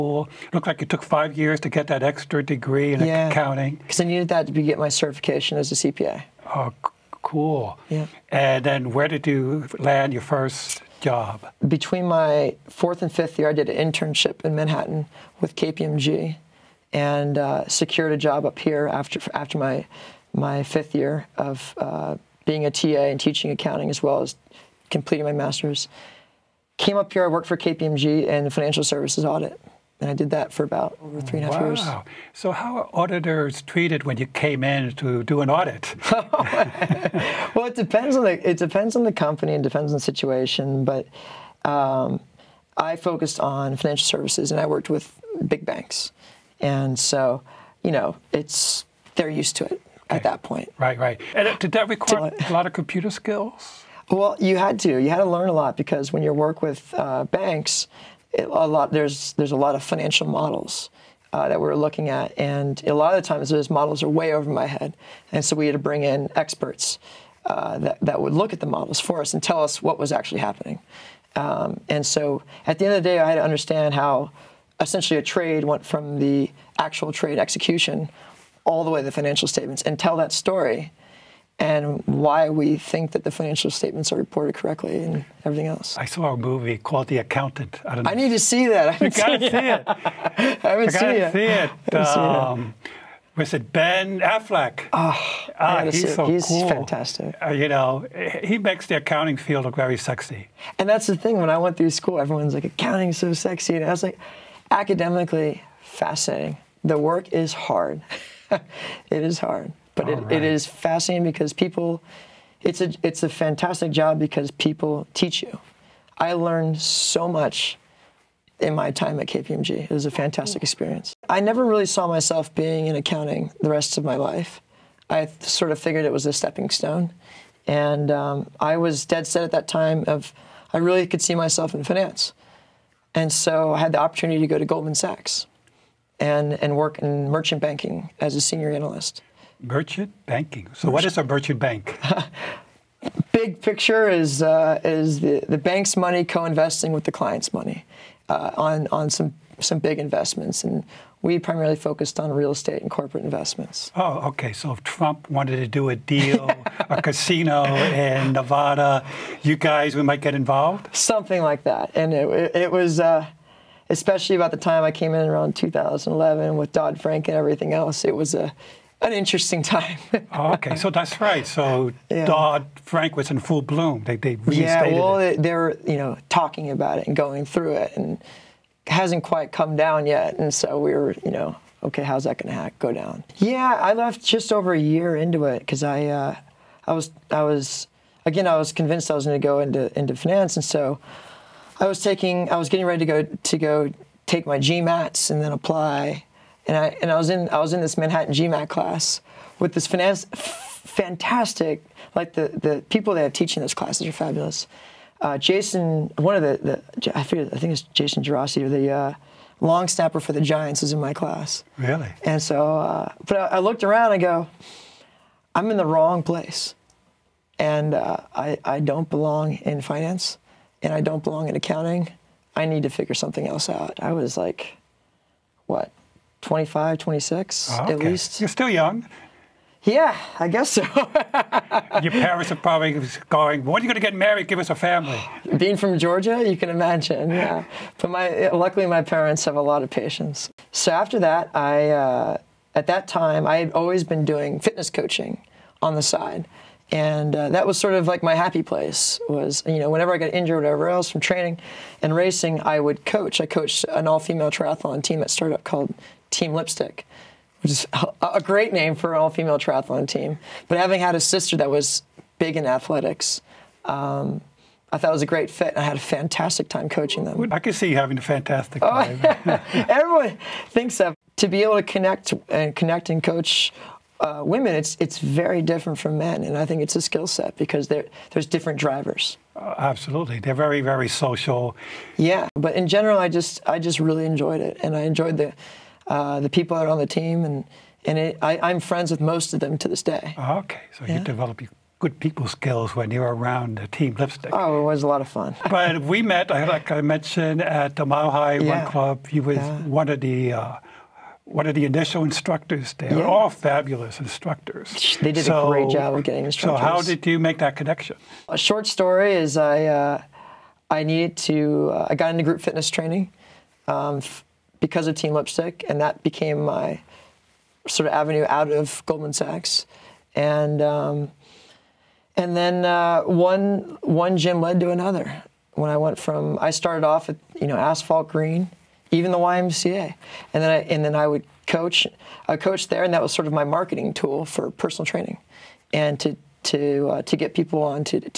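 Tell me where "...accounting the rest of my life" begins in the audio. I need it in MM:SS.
02:02.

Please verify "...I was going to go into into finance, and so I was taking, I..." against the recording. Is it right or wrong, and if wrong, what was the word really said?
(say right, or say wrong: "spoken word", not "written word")
right.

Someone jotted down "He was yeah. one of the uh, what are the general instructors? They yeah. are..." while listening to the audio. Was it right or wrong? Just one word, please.
wrong.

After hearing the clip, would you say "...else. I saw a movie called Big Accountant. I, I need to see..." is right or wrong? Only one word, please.
wrong.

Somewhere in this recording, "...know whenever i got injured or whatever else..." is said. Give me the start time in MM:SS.
04:09.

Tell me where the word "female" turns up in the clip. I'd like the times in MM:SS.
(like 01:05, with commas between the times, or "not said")
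04:14, 04:19.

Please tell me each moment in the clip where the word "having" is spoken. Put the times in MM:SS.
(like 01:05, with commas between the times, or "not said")
04:20, 04:27.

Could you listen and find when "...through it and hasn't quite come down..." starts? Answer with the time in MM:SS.
02:57.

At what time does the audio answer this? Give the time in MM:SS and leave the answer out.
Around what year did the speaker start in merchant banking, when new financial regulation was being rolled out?
02:45.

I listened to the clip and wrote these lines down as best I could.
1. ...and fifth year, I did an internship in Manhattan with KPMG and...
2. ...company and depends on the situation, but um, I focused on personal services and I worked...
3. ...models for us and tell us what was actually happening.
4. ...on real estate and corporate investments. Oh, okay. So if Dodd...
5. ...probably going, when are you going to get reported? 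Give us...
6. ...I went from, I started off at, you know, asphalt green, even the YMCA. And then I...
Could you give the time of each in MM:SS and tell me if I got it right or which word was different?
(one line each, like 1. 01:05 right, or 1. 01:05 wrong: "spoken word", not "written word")
1. 00:13 right
2. 00:39 wrong: "financial", not "personal"
3. 01:08 right
4. 02:32 wrong: "Trump", not "Dodd"
5. 03:52 wrong: "married", not "reported"
6. 05:25 right.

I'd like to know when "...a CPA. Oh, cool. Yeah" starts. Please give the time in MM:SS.
00:05.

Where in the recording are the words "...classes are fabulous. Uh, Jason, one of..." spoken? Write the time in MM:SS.
03:23.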